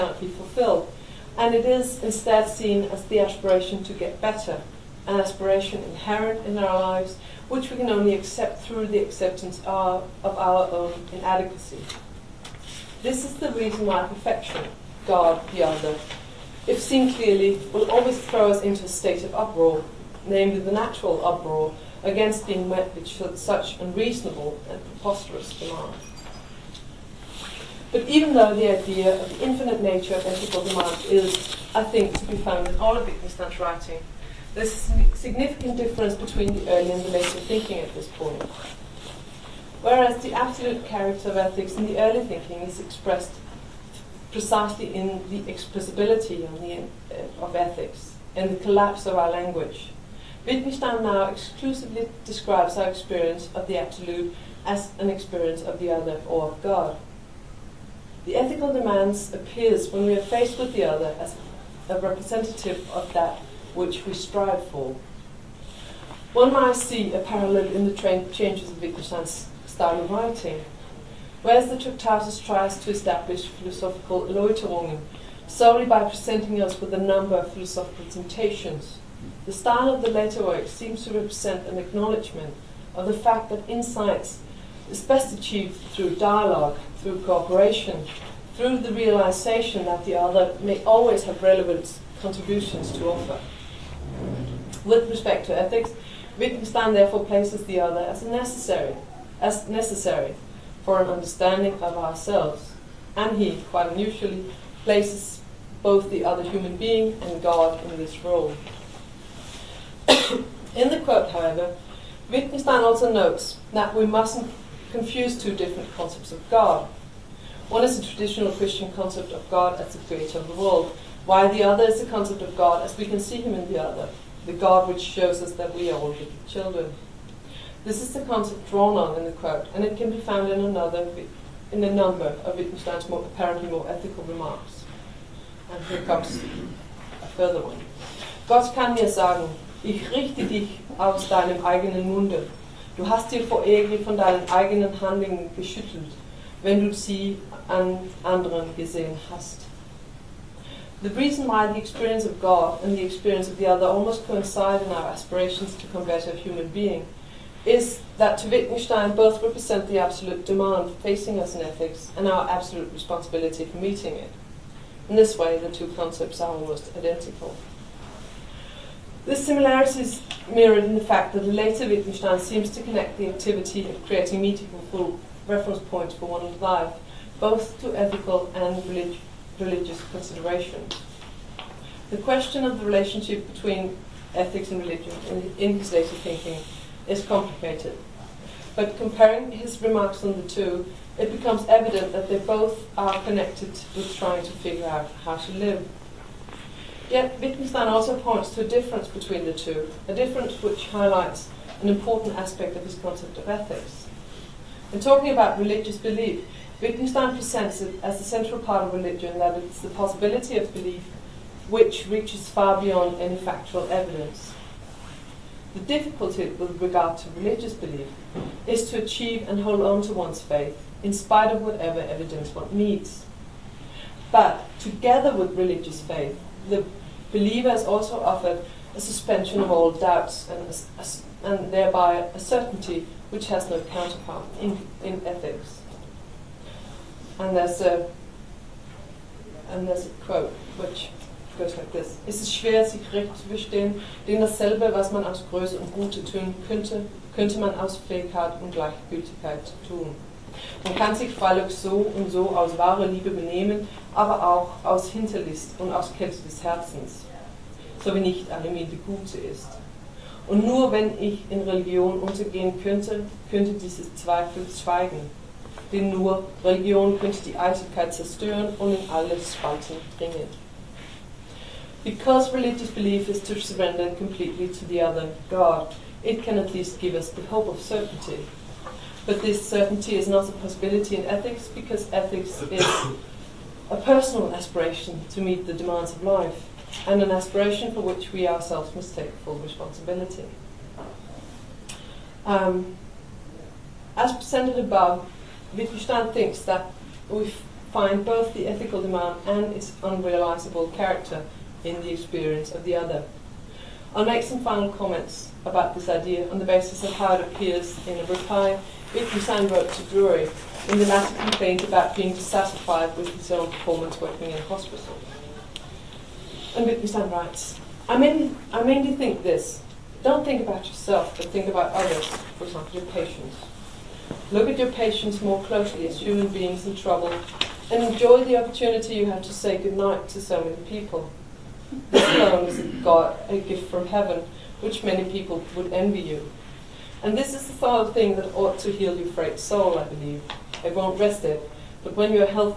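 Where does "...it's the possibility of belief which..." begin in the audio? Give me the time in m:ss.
3:29.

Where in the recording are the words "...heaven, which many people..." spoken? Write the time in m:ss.
5:34.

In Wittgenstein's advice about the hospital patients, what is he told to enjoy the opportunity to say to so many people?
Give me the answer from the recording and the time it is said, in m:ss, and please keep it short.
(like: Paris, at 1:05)
goodnight, at 5:29.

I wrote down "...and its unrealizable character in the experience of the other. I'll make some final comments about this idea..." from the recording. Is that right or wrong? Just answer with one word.
right.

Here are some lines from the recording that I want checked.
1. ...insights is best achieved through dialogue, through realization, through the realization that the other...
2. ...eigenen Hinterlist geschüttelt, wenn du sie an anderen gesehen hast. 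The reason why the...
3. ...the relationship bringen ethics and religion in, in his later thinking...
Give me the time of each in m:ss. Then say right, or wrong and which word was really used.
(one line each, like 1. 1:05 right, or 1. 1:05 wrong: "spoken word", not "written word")
1. 1:23 wrong: "cooperation", not "realization"
2. 2:24 wrong: "Handlungen", not "Hinterlist"
3. 3:02 wrong: "between", not "bringen".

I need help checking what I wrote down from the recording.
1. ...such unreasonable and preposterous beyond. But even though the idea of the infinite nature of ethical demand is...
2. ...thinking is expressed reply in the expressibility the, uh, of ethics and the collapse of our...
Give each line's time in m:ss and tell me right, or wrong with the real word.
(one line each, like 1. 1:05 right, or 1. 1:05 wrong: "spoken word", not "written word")
1. 0:23 wrong: "demand", not "beyond"
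2. 0:42 wrong: "precisely", not "reply".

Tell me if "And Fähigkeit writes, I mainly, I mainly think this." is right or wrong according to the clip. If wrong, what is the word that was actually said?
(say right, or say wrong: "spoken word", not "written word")
wrong: "Wittgenstein", not "Fähigkeit".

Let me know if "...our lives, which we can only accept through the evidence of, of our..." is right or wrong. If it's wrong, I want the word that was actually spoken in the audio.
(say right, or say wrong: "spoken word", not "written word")
wrong: "acceptance", not "evidence".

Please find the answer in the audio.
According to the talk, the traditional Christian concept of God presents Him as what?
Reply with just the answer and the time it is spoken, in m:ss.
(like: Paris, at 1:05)
the creator of the world, at 1:59.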